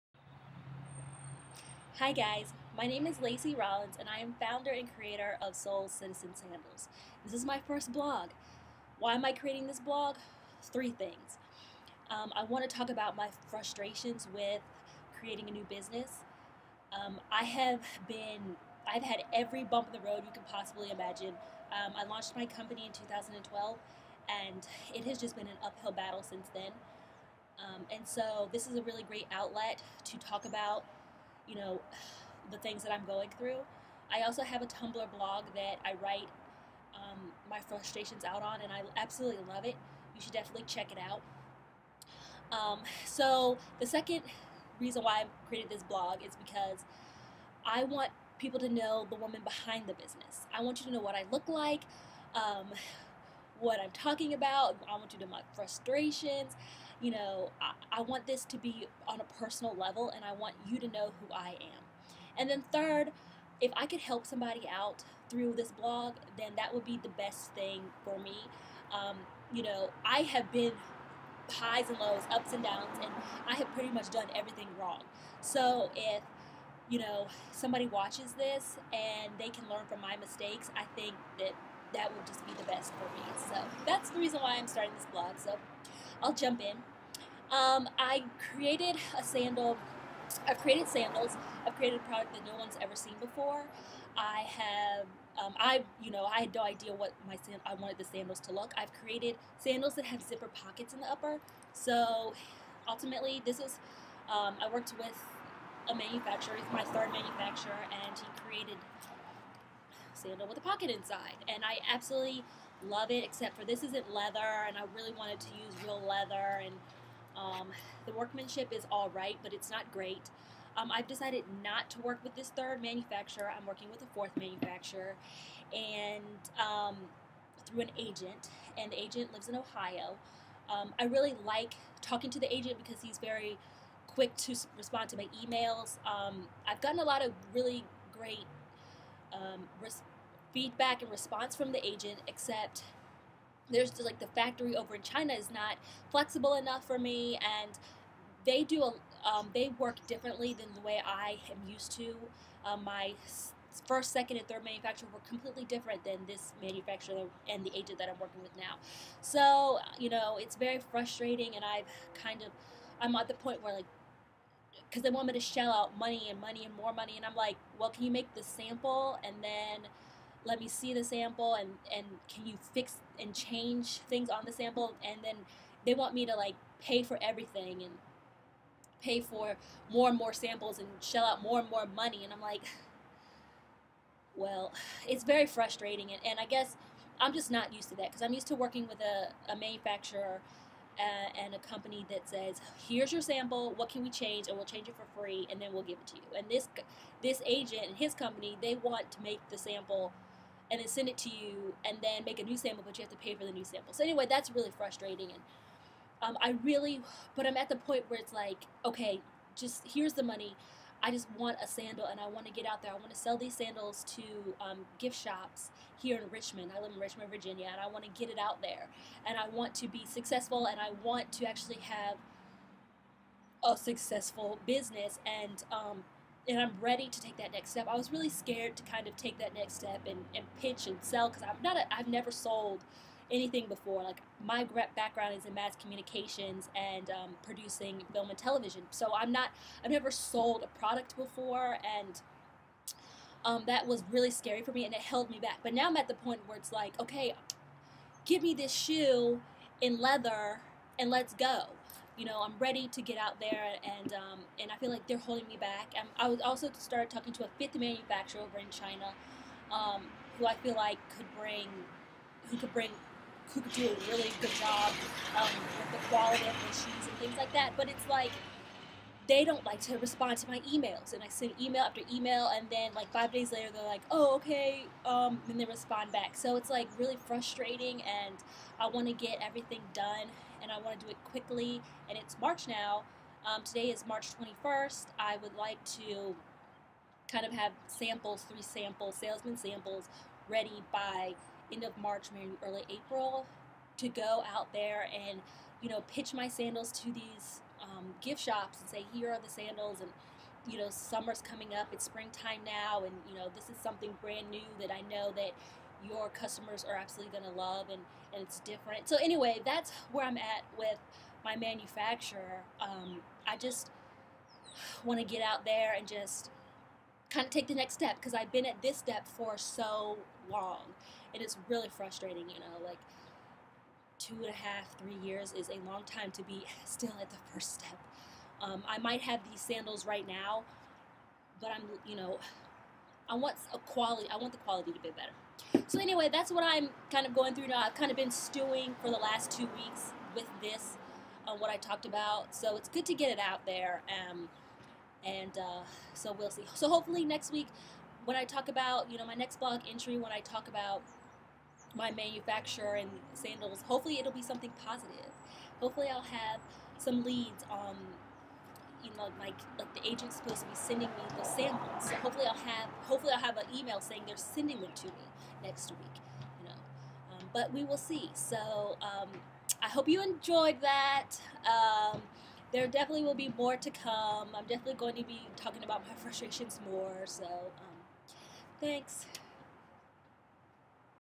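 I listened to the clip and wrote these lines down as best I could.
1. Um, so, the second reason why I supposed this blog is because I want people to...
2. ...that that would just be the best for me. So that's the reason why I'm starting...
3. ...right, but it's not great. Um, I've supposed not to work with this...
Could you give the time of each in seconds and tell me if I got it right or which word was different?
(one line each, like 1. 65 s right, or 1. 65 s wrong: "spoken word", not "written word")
1. 42 s wrong: "created", not "supposed"
2. 81 s right
3. 119 s wrong: "decided", not "supposed".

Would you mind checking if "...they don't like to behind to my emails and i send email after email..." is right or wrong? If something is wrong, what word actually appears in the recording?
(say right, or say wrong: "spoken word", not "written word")
wrong: "respond", not "behind".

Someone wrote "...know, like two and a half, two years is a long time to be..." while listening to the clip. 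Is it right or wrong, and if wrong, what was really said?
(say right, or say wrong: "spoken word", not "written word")
wrong: "three", not "two".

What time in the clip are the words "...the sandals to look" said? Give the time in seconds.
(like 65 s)
97 s.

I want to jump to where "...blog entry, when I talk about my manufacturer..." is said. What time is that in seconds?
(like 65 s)
349 s.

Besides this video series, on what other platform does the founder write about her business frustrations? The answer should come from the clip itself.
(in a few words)
Tumblr.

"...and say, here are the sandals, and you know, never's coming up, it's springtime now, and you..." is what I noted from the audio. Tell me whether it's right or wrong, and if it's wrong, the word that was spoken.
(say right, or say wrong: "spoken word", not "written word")
wrong: "summer", not "never".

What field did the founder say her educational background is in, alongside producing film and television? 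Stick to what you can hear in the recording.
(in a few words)
Mass communications.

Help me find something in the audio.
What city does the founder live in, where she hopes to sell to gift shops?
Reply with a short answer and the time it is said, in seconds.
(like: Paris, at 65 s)
Richmond, Virginia, at 217 s.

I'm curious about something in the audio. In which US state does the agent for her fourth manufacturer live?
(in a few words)
Ohio.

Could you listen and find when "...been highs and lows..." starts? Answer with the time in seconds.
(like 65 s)
70 s.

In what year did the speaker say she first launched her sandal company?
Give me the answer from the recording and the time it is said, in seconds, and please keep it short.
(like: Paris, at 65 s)
2012, at 22 s.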